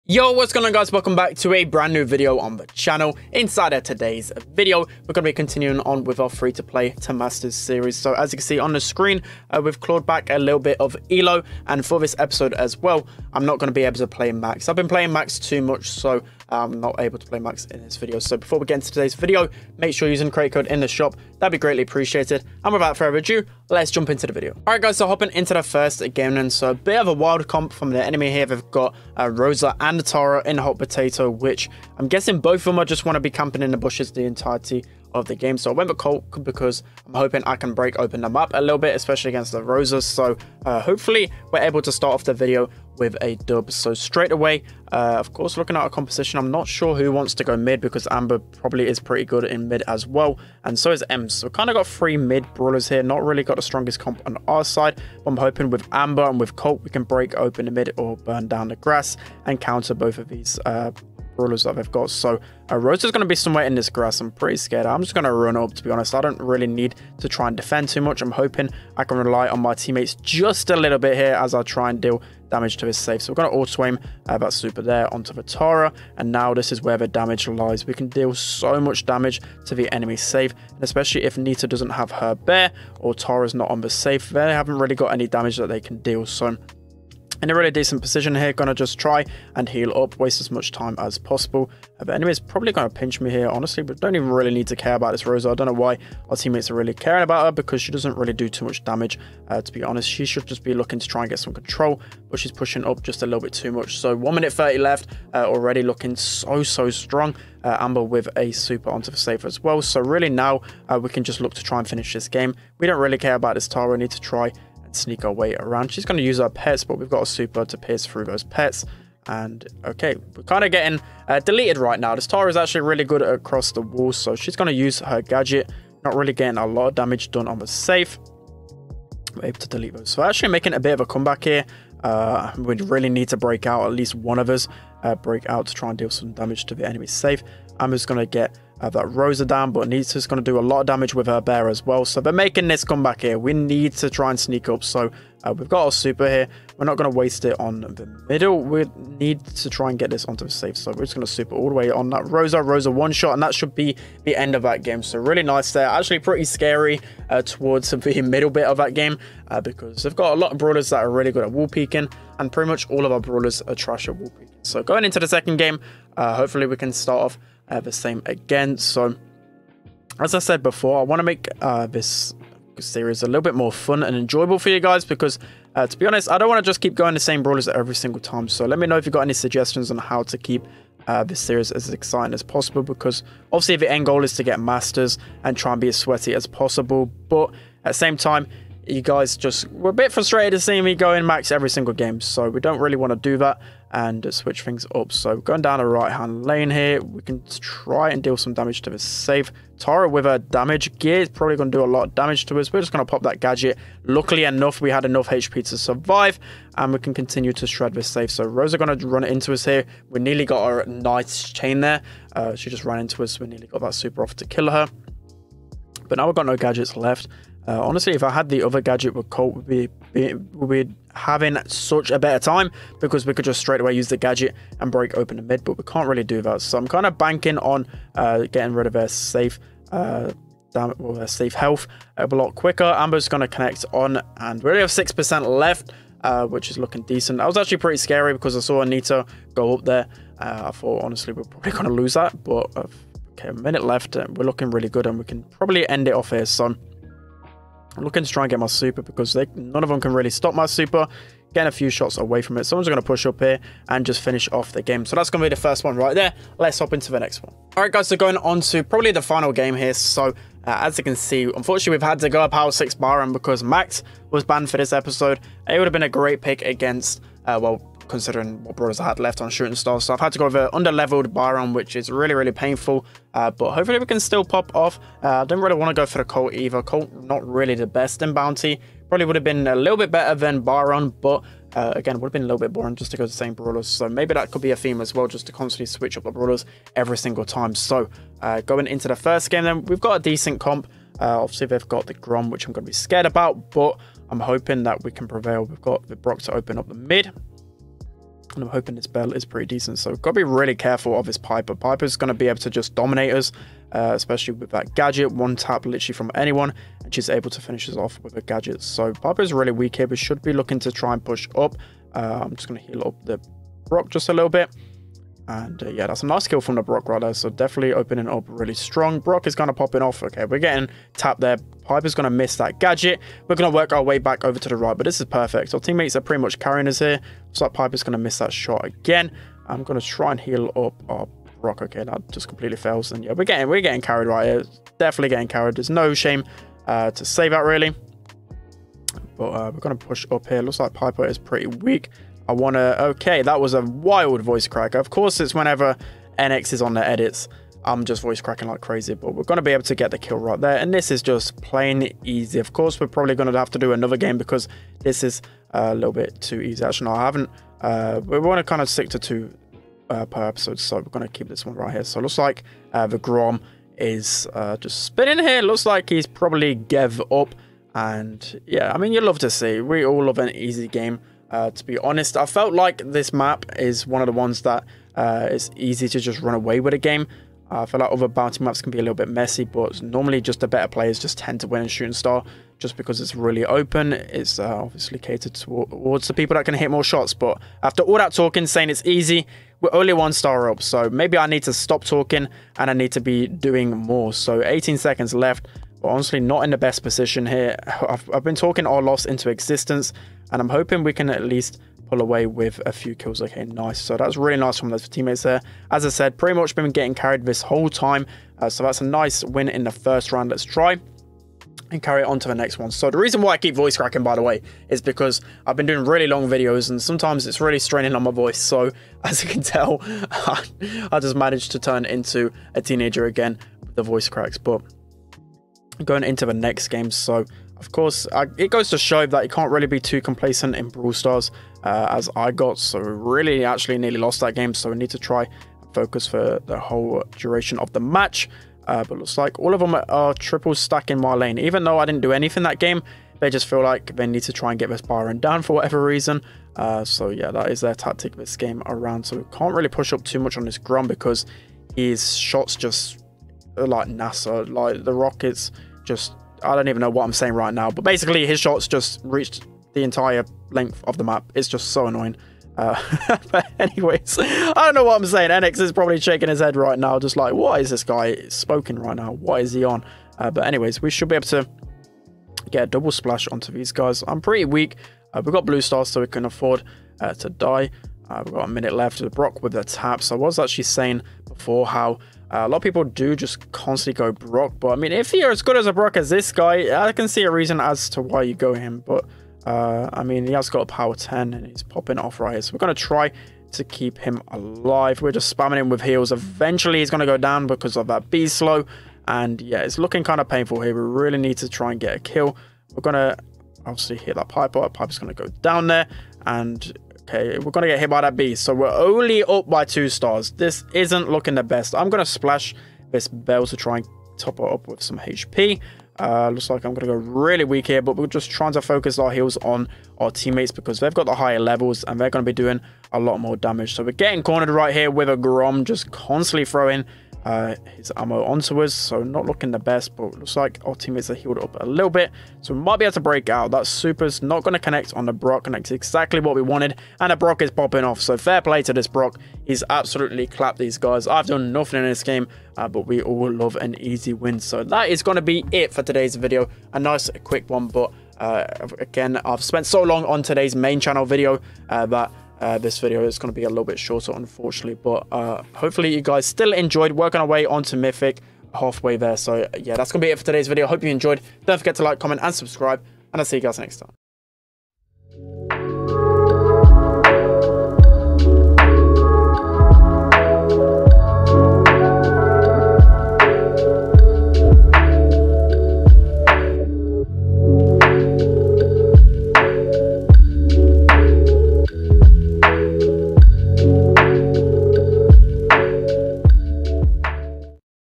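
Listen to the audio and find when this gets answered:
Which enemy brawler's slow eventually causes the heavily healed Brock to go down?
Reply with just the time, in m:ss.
8:18.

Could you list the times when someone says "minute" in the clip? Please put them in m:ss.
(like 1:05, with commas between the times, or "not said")
1:44, 4:03, 7:58.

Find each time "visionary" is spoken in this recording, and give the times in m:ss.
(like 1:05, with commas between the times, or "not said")
not said.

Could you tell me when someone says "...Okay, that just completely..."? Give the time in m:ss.
5:31.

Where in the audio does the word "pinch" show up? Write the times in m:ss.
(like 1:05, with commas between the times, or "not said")
1:32.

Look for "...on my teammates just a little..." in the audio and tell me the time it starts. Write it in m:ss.
1:09.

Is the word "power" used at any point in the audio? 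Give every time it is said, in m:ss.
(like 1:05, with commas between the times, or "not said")
4:22, 8:10.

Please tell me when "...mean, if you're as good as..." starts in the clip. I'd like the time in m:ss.
8:04.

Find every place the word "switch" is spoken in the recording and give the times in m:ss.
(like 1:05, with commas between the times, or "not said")
3:14, 4:45.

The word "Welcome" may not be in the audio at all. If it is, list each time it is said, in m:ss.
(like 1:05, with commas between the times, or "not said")
0:00.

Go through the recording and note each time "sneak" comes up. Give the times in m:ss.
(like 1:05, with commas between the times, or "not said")
1:54, 2:24.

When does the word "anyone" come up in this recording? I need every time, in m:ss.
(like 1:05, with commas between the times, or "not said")
5:06.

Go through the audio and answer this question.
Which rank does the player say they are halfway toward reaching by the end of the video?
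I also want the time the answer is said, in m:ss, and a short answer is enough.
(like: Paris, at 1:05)
Mythic, at 9:17.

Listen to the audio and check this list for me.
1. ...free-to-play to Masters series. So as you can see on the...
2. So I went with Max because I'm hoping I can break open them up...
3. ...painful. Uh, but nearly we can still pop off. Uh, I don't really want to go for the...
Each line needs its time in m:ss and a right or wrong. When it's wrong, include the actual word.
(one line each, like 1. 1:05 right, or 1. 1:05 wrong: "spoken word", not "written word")
1. 0:06 right
2. 0:35 wrong: "Colt", not "Max"
3. 4:32 wrong: "hopefully", not "nearly".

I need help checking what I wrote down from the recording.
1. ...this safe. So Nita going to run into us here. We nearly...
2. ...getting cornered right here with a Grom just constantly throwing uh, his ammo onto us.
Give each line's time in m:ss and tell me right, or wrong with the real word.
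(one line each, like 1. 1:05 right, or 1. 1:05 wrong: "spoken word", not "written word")
1. 3:27 wrong: "Rosa", not "Nita"
2. 8:44 right.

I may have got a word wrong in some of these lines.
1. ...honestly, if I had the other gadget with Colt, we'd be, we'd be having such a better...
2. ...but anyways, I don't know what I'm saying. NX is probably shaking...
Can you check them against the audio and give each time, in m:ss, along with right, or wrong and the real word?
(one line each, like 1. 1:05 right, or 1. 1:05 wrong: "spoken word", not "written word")
1. 3:37 right
2. 7:43 right.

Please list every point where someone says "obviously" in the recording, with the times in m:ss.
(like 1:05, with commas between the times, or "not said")
3:03, 4:51, 6:24, 8:23.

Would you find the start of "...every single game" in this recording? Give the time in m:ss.
3:11.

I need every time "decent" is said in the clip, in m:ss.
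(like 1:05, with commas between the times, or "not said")
1:27, 3:57, 4:50, 4:59.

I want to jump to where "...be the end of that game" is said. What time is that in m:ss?
2:33.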